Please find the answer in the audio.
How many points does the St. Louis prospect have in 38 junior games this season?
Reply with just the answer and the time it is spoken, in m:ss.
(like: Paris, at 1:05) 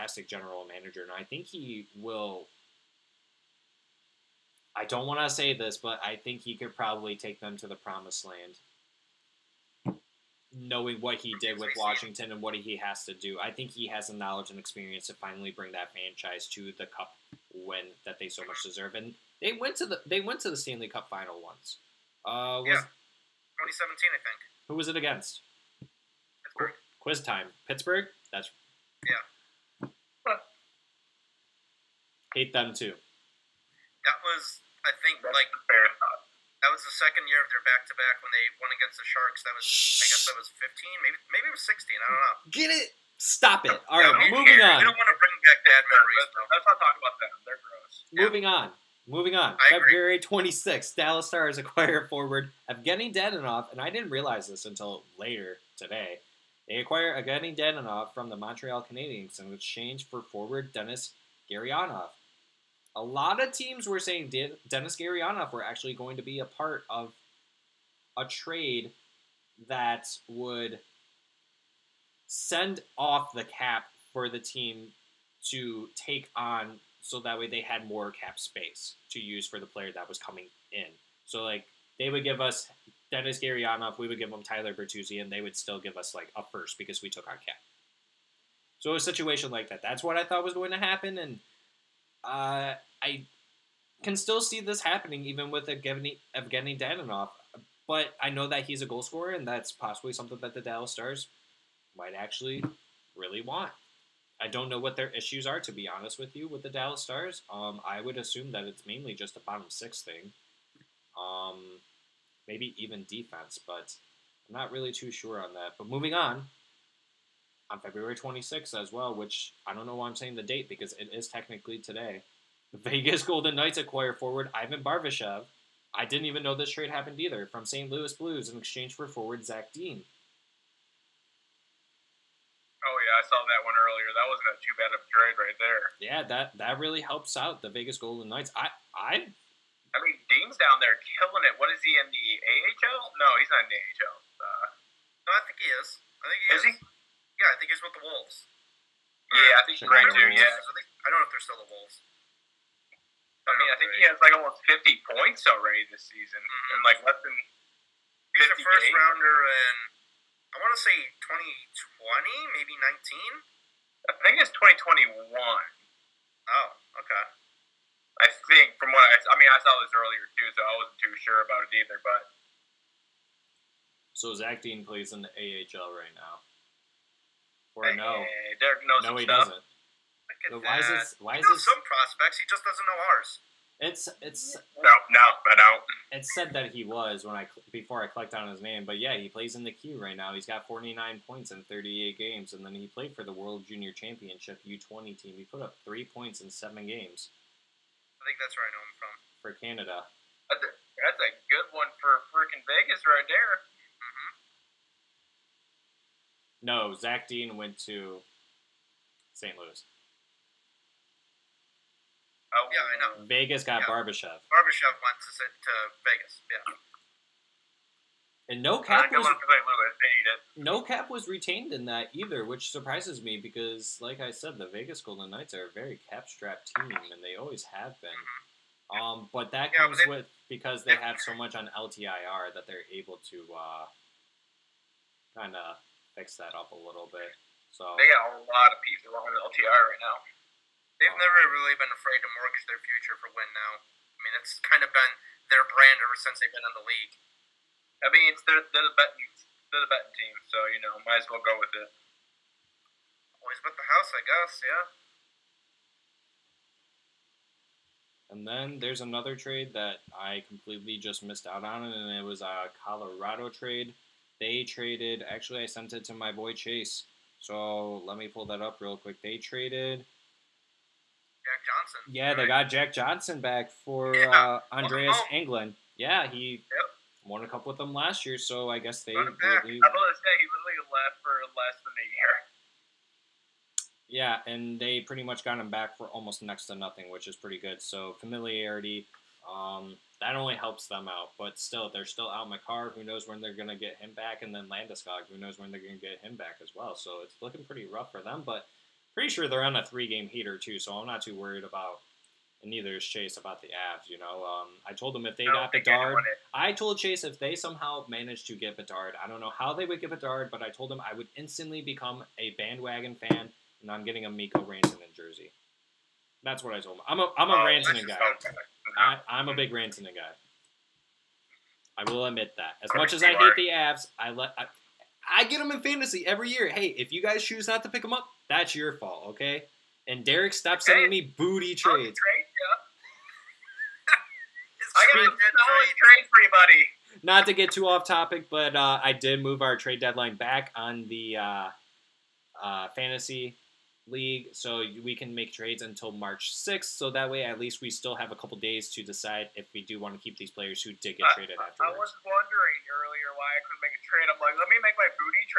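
49, at 3:10.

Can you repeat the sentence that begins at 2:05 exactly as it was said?
I didn't even know this trade happened either from St.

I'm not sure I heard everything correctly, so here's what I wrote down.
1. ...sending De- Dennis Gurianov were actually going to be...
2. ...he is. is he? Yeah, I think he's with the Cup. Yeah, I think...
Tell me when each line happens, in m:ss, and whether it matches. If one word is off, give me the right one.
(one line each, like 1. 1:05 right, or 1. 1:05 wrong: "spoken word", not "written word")
1. 1:03 wrong: "saying", not "sending"
2. 2:26 wrong: "Wolves", not "Cup".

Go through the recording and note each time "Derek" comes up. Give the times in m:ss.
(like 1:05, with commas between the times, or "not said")
2:58, 5:30.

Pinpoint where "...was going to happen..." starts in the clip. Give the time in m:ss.
1:30.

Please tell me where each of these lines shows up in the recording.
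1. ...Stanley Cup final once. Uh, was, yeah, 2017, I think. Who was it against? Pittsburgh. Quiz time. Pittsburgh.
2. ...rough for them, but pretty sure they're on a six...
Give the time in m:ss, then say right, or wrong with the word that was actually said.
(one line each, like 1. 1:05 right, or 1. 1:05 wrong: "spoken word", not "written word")
1. 0:20 right
2. 4:57 wrong: "three", not "six".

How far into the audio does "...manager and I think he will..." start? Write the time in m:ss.
0:00.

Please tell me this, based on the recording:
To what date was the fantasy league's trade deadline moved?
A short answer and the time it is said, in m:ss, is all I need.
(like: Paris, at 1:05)
March 6th, at 5:46.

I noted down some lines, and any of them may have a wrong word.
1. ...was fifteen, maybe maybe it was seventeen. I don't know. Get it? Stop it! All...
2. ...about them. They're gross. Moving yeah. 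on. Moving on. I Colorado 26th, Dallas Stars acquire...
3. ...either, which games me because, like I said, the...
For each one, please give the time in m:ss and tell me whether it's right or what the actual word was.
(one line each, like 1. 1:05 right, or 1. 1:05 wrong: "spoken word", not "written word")
1. 0:40 wrong: "sixteen", not "seventeen"
2. 0:47 wrong: "February", not "Colorado"
3. 3:42 wrong: "surprises", not "games".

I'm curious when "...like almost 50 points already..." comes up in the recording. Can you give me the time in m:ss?
2:34.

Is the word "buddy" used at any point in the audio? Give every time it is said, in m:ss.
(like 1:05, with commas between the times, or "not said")
5:36.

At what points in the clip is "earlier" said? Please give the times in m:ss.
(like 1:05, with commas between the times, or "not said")
2:13, 2:49, 5:52.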